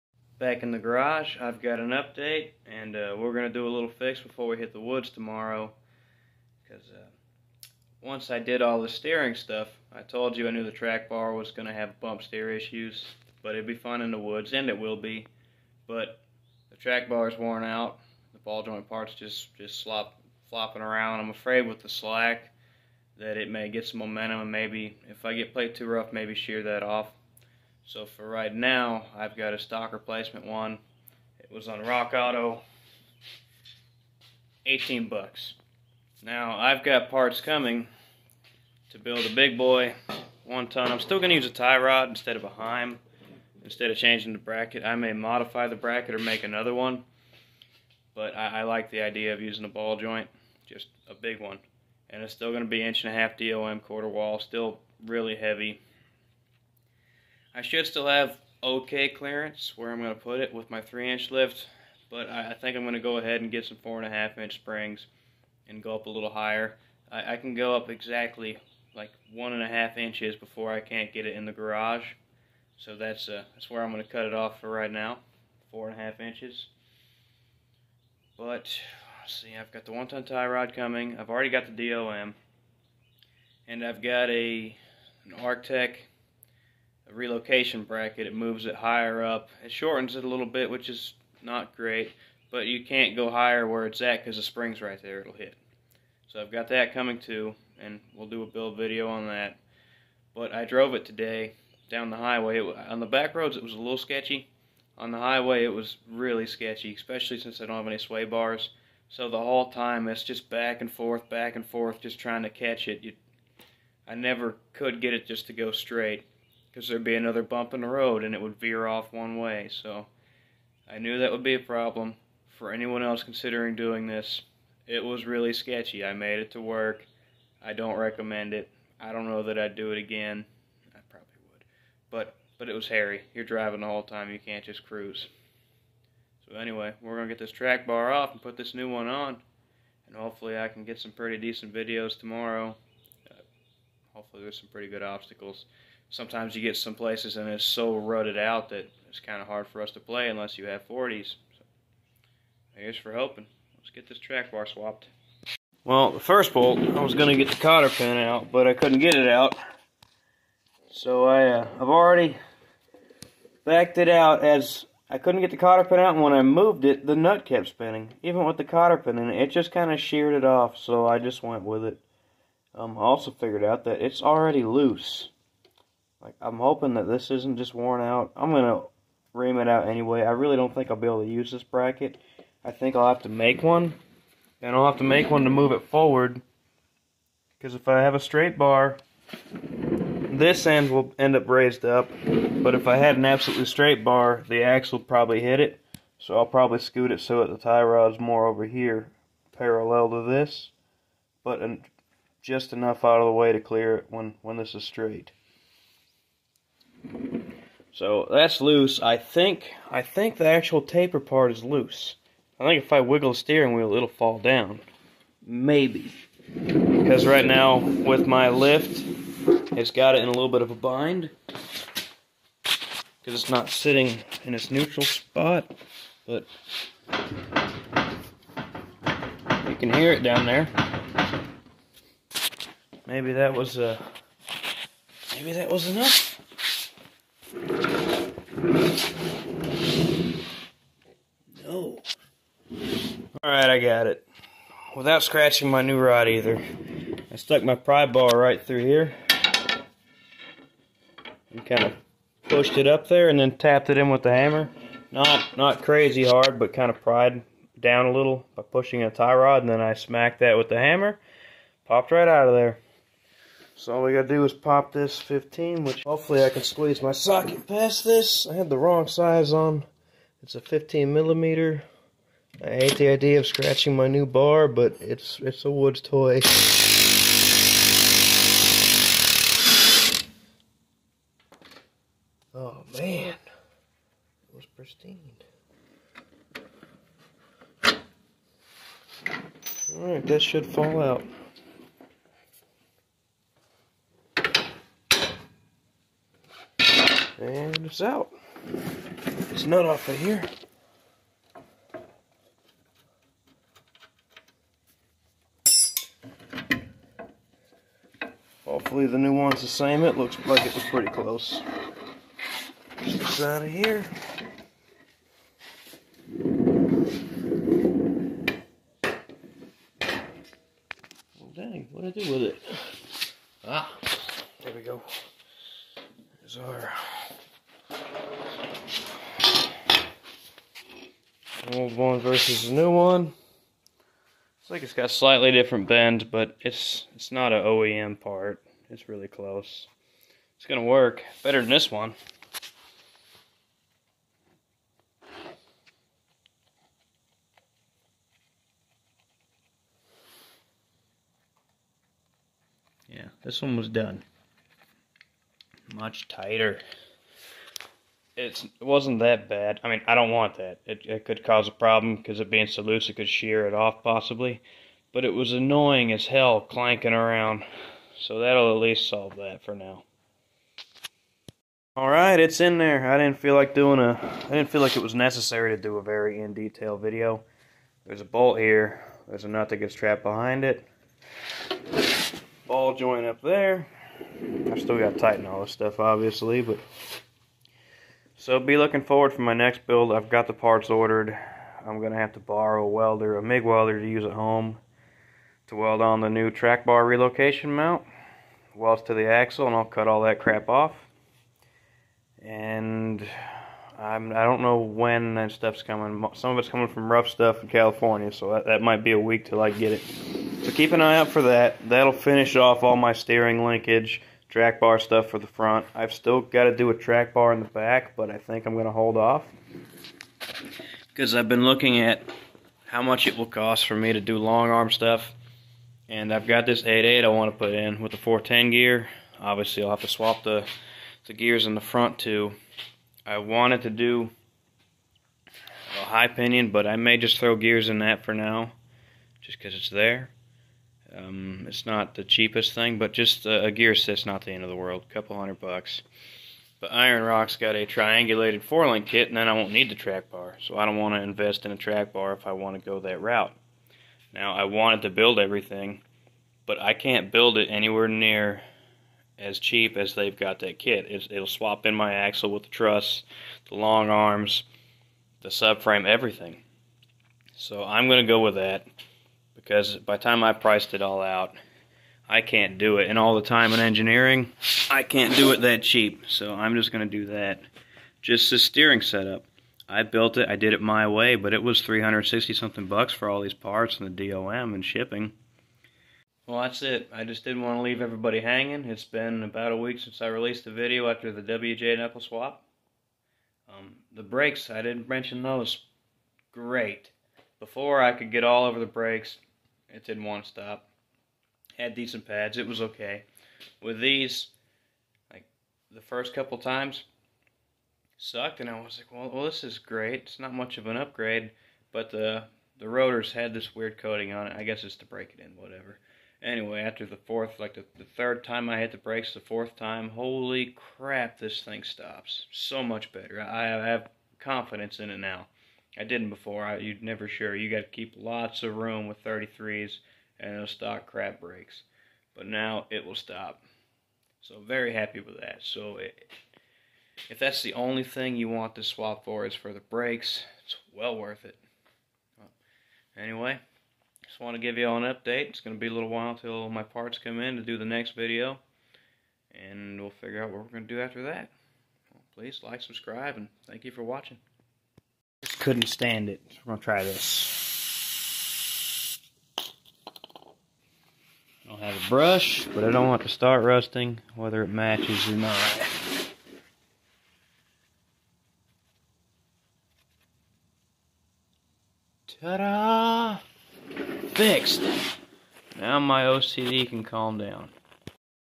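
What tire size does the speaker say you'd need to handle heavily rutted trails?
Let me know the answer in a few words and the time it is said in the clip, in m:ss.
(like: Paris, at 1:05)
40s, at 2:30.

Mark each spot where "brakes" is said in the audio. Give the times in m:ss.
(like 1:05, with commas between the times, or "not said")
8:14, 8:18, 8:38, 8:51, 8:59.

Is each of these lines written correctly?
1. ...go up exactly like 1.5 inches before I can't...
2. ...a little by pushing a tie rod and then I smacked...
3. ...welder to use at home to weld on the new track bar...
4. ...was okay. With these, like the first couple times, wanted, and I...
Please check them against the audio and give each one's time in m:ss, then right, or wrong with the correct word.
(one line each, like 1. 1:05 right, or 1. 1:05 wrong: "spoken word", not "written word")
1. 1:07 right
2. 4:18 right
3. 6:33 right
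4. 8:22 wrong: "sucked", not "wanted".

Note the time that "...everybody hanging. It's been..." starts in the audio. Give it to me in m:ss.
8:08.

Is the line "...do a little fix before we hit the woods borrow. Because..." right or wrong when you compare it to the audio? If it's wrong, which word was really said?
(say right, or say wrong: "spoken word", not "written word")
wrong: "tomorrow", not "borrow".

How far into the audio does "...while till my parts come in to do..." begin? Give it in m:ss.
9:06.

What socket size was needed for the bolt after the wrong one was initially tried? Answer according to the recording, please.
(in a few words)
15 millimeter.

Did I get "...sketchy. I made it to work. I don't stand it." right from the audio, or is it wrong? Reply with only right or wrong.
wrong.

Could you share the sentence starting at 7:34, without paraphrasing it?
Now, I wanted to build everything, but I can't build it anywhere near as cheap as they've got that kit.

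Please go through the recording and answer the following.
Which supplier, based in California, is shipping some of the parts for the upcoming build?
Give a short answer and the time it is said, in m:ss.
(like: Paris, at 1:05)
RuffStuff, at 6:47.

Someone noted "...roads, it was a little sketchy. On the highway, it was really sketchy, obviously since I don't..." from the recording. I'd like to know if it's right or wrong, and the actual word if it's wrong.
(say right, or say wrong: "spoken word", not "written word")
wrong: "especially", not "obviously".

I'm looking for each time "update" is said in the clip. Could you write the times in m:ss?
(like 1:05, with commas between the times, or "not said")
0:01, 9:05.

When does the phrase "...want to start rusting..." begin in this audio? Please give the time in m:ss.
9:23.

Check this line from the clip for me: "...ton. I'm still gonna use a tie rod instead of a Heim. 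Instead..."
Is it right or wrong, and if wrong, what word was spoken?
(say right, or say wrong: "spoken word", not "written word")
right.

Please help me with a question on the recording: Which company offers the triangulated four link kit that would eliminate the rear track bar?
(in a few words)
Iron Rock.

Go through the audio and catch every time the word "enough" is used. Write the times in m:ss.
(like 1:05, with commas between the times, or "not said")
3:22, 3:55.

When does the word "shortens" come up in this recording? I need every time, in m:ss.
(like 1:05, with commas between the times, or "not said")
1:29.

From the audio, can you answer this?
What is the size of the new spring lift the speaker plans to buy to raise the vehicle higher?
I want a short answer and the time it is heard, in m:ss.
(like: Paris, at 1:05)
4.5 inch, at 1:03.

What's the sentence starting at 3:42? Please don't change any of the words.
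Because it's not sitting in its neutral spot.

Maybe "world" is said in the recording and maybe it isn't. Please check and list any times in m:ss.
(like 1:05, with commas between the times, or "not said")
7:24.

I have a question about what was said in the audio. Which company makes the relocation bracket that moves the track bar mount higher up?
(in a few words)
Artec.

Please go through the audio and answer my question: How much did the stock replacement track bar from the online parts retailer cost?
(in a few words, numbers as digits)
$18.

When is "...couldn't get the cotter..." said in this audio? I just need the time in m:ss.
2:45.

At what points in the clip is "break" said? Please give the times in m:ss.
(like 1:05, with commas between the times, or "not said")
8:35.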